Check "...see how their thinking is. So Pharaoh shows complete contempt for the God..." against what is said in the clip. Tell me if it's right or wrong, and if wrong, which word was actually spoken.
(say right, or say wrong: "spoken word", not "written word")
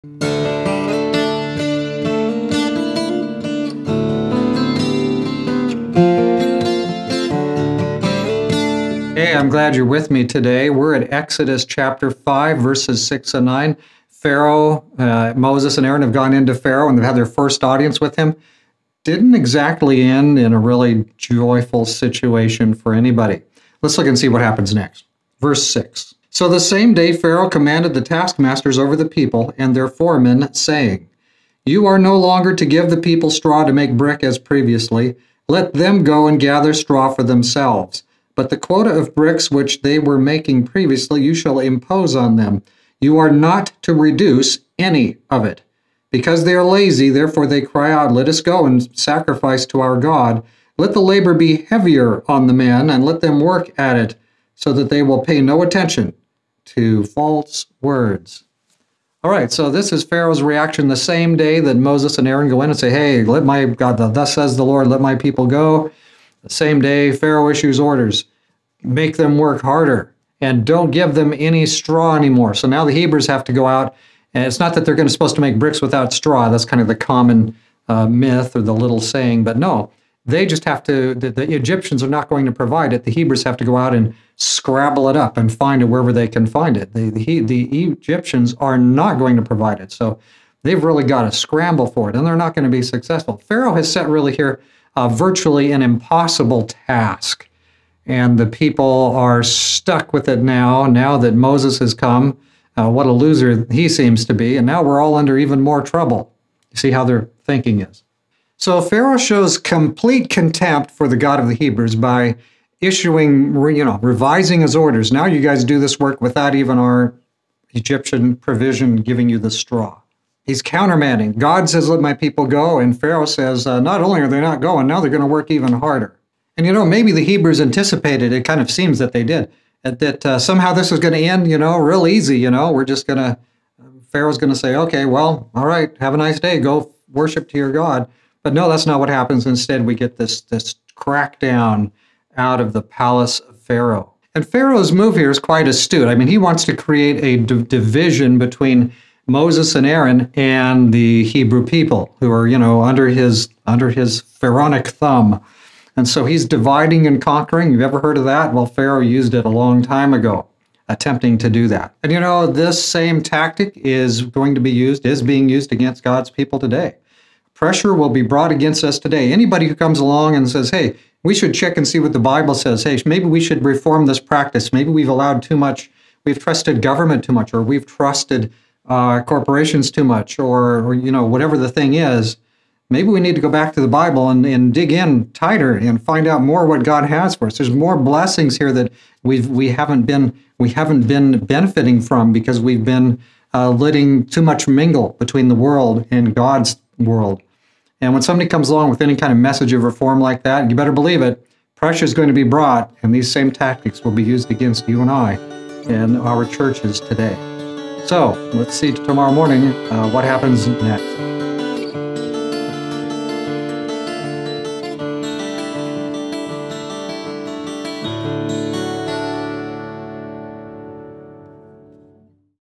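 right.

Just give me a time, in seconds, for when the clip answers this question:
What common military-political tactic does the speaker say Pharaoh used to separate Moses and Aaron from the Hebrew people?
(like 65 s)
156 s.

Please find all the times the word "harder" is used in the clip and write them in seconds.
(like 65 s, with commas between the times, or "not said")
69 s, 125 s.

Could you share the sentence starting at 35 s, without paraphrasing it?
Let them go and gather straw for themselves.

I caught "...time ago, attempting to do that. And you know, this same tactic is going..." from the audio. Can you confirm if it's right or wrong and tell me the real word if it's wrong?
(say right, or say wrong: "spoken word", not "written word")
right.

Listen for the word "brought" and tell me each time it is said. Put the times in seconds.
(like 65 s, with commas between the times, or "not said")
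168 s, 202 s.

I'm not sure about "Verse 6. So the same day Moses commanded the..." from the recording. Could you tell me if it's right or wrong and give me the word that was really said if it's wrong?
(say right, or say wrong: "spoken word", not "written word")
wrong: "Pharaoh", not "Moses".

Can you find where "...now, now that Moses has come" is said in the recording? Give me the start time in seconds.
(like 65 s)
100 s.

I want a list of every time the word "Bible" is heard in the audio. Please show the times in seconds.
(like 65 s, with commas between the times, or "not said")
172 s, 183 s.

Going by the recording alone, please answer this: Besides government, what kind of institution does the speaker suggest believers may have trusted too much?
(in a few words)
Corporations.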